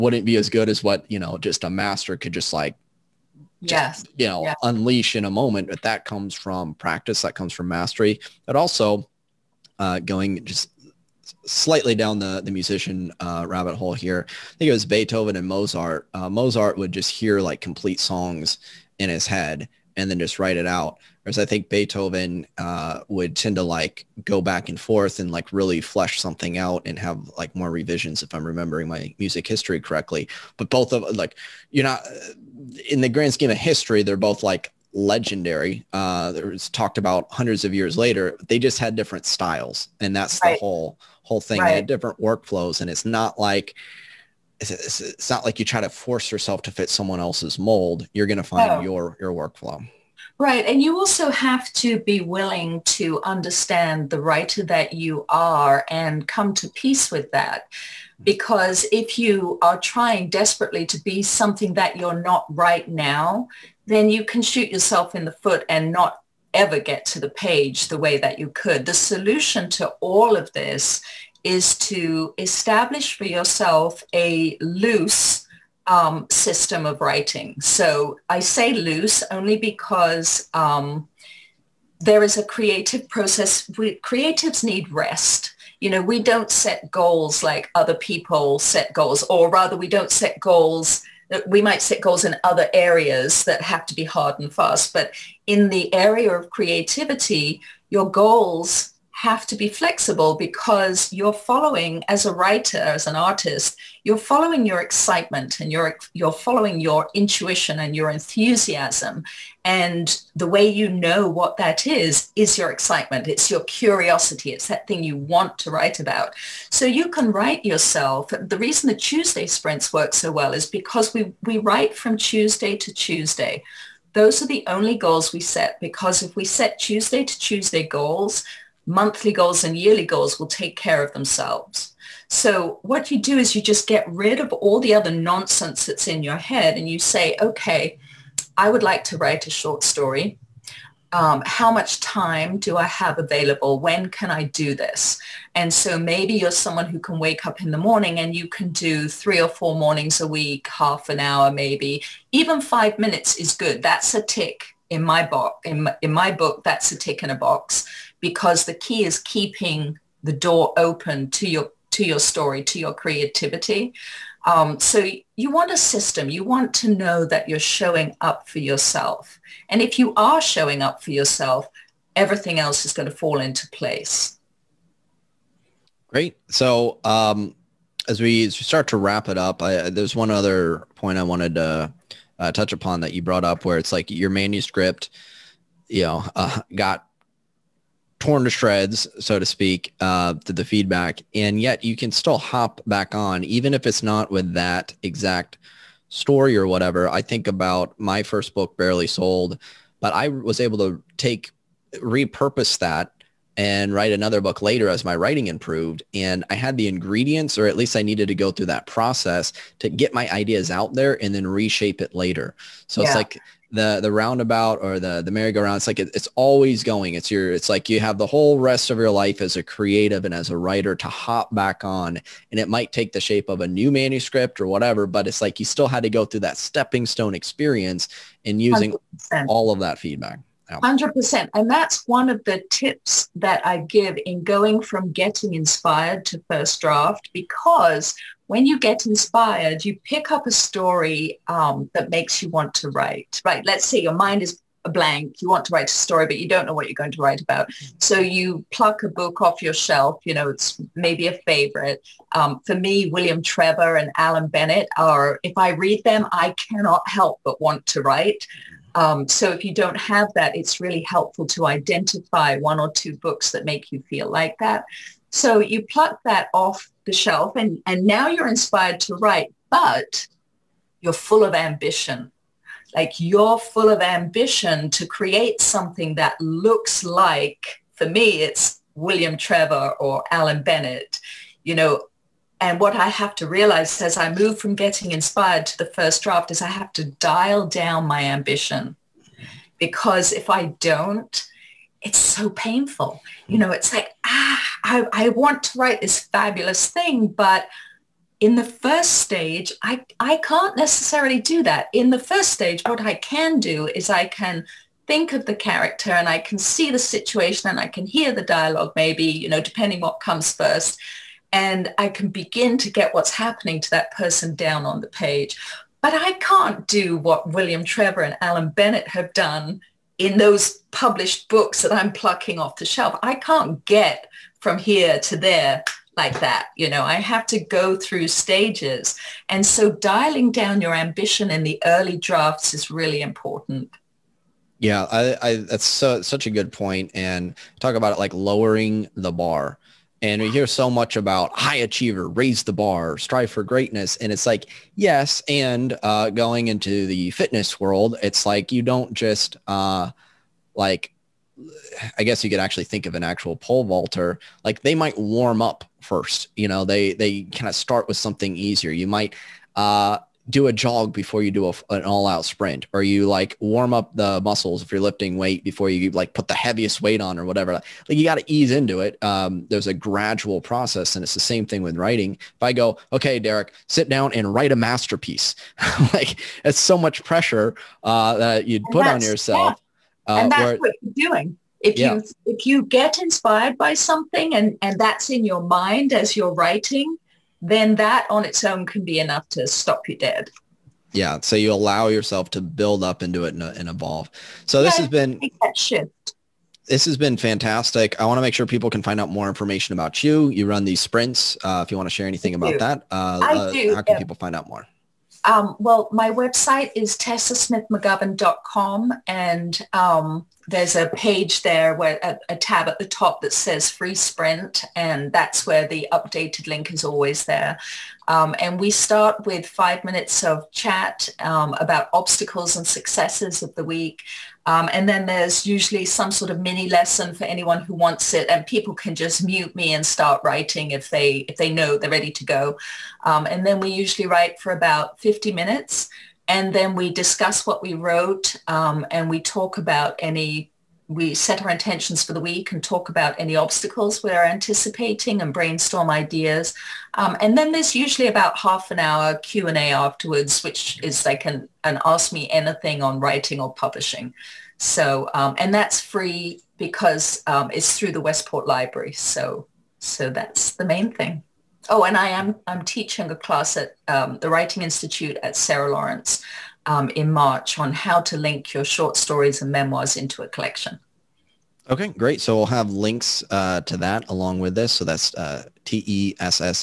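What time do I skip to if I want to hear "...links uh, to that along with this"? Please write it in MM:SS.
07:52.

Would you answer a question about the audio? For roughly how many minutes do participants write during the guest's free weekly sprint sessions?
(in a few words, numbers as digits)
50 minutes.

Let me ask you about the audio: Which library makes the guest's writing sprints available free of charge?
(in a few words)
Westport Library.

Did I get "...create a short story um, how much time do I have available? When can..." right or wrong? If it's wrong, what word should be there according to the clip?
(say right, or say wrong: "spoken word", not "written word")
wrong: "write", not "create".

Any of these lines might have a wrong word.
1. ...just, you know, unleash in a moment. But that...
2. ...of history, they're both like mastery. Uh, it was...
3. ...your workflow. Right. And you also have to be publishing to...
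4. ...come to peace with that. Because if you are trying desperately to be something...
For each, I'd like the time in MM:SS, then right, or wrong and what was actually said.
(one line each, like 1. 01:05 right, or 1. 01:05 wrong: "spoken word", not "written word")
1. 00:04 right
2. 00:33 wrong: "legendary", not "mastery"
3. 00:49 wrong: "willing", not "publishing"
4. 00:56 right.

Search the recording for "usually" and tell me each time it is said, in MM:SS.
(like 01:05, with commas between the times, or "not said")
07:05, 07:13, 07:27.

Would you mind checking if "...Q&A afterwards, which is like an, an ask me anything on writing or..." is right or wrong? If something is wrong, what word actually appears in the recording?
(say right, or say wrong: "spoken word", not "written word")
right.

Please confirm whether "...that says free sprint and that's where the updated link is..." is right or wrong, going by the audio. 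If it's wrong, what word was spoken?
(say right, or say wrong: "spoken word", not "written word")
right.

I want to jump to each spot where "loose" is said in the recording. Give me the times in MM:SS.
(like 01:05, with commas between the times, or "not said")
01:14, 01:18.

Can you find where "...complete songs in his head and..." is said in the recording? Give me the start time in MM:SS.
00:17.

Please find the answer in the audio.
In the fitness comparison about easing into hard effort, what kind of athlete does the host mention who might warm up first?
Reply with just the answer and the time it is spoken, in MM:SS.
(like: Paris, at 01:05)
Pole vaulter, at 05:53.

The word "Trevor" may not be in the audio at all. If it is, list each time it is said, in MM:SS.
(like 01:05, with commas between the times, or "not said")
04:13, 04:39, 05:17.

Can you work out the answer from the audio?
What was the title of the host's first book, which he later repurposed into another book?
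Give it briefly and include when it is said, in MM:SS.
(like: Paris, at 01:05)
Barely Sold, at 03:18.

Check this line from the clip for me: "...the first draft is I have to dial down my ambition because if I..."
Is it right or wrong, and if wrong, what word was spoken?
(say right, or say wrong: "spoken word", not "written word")
right.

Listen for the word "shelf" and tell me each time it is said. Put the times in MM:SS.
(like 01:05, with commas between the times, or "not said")
04:09, 04:27, 05:22.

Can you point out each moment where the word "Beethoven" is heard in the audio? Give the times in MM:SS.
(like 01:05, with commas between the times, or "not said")
00:14, 00:21.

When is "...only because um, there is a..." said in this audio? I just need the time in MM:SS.
01:19.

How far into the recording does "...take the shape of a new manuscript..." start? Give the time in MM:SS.
03:42.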